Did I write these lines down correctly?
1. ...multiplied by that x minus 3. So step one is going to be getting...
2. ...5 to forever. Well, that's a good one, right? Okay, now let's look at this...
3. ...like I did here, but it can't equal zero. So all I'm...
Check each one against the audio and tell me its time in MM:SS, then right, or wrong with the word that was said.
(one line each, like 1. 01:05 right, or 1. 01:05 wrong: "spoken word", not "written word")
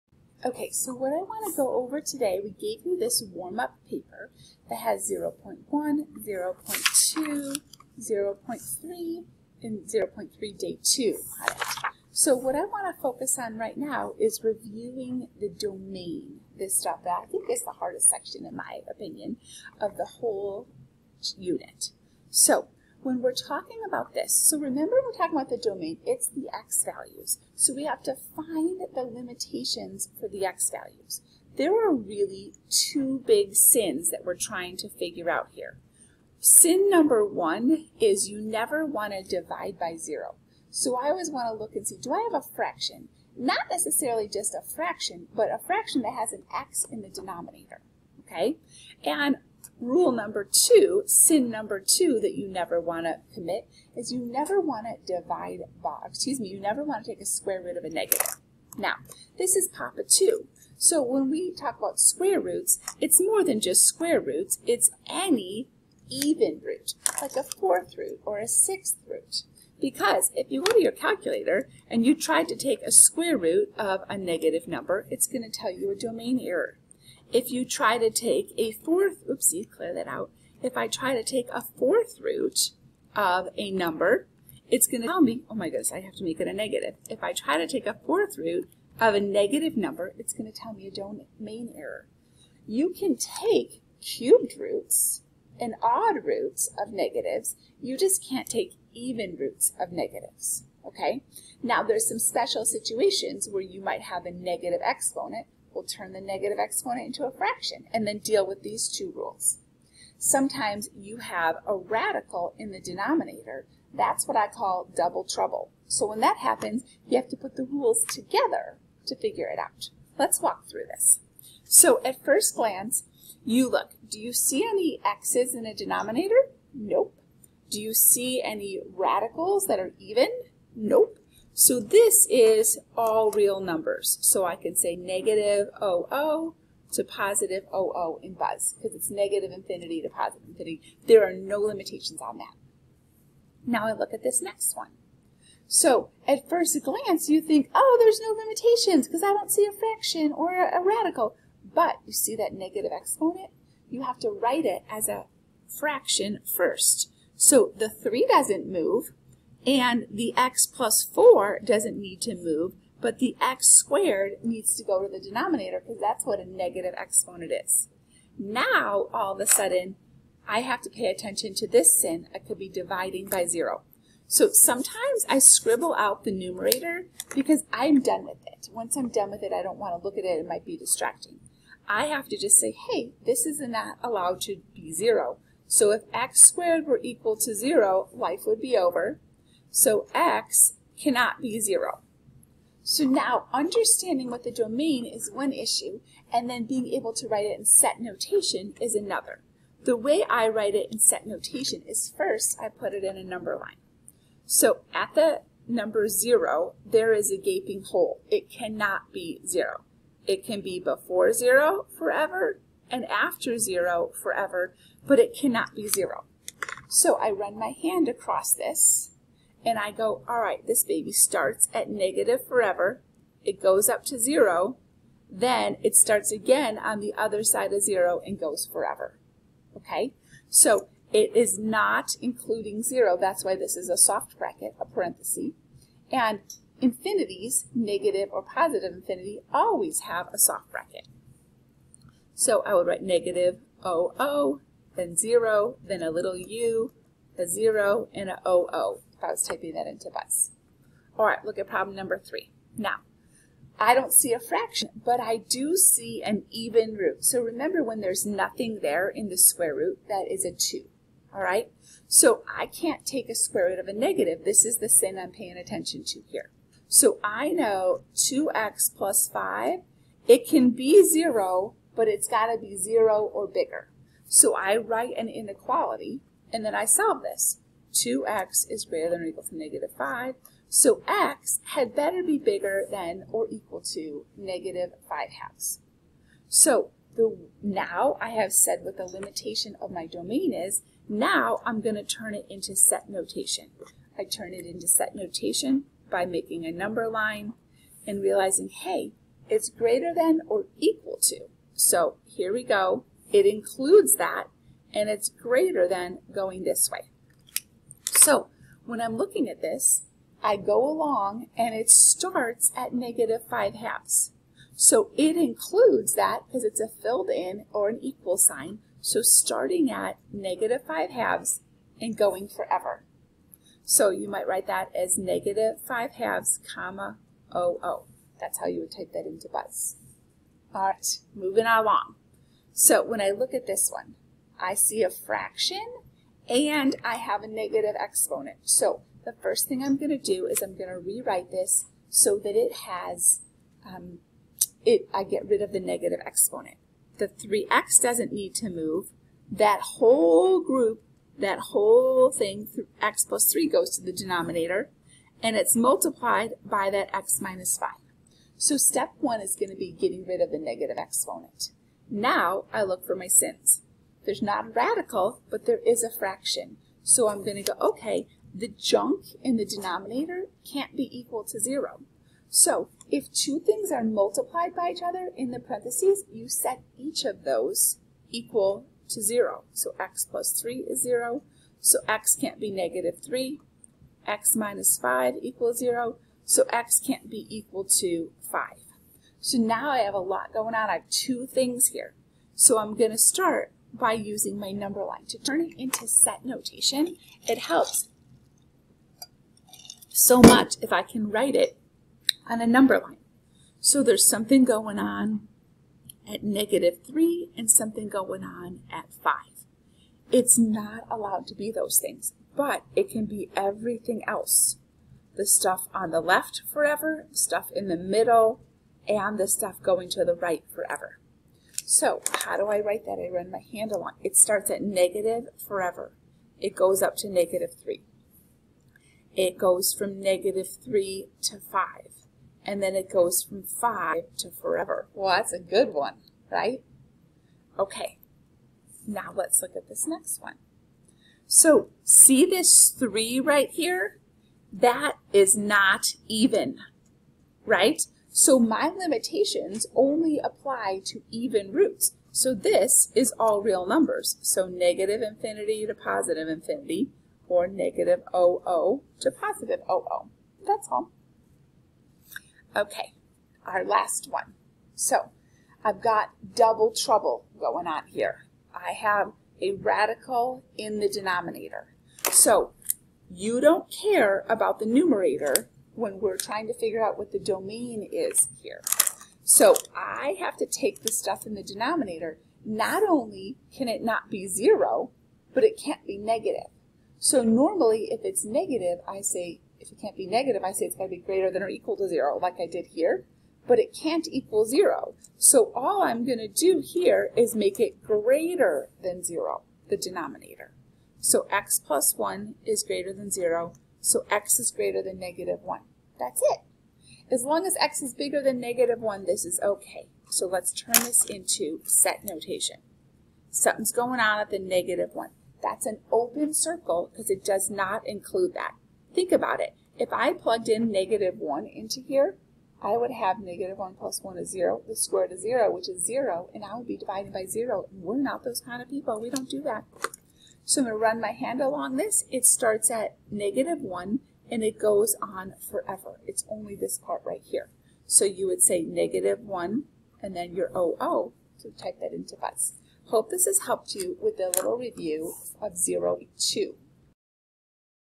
1. 05:55 wrong: "5", not "3"
2. 07:13 right
3. 08:12 right.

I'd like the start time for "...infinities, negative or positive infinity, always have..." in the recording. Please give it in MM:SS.
03:56.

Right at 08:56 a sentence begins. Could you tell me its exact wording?
It's only this part right here.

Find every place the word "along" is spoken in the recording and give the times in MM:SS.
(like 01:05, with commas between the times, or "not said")
05:10, 05:31, 07:03, 08:51.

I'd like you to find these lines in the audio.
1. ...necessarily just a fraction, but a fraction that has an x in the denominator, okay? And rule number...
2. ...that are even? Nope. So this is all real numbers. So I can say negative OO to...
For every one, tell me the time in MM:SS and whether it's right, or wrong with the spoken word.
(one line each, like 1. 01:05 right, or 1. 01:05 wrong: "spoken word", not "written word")
1. 00:43 right
2. 02:09 right.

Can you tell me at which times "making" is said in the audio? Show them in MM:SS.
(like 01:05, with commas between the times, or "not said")
04:56.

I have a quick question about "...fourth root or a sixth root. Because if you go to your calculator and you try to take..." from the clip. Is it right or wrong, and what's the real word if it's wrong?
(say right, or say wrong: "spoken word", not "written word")
right.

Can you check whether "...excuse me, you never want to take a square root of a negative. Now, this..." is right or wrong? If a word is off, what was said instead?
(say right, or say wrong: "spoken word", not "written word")
right.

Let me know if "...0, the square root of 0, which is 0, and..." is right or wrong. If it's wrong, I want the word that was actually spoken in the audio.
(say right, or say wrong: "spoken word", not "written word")
right.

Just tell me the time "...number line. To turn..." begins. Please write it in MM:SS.
06:34.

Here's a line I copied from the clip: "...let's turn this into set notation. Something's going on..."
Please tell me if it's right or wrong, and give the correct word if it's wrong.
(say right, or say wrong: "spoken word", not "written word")
right.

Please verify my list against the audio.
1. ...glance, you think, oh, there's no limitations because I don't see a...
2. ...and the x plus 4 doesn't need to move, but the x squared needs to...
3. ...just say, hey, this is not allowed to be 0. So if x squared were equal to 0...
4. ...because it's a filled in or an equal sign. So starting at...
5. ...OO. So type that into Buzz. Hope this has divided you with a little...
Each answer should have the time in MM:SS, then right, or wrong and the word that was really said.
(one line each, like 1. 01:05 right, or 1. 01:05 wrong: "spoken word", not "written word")
1. 02:26 right
2. 02:39 right
3. 03:02 right
4. 05:16 right
5. 09:00 wrong: "helped", not "divided".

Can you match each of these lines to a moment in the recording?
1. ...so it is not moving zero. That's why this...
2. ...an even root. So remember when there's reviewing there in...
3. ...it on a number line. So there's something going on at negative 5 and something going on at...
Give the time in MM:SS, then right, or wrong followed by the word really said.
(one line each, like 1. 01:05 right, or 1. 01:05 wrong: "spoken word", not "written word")
1. 03:50 wrong: "including", not "moving"
2. 04:16 wrong: "nothing", not "reviewing"
3. 06:41 wrong: "3", not "5".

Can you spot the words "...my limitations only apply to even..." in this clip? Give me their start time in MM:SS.
07:28.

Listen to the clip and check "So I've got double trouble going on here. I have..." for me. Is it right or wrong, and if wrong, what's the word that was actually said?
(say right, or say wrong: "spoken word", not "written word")
right.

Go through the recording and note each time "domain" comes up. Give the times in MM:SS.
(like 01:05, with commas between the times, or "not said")
00:15, 00:25, 01:15, 01:30, 03:14, 04:50, 07:57.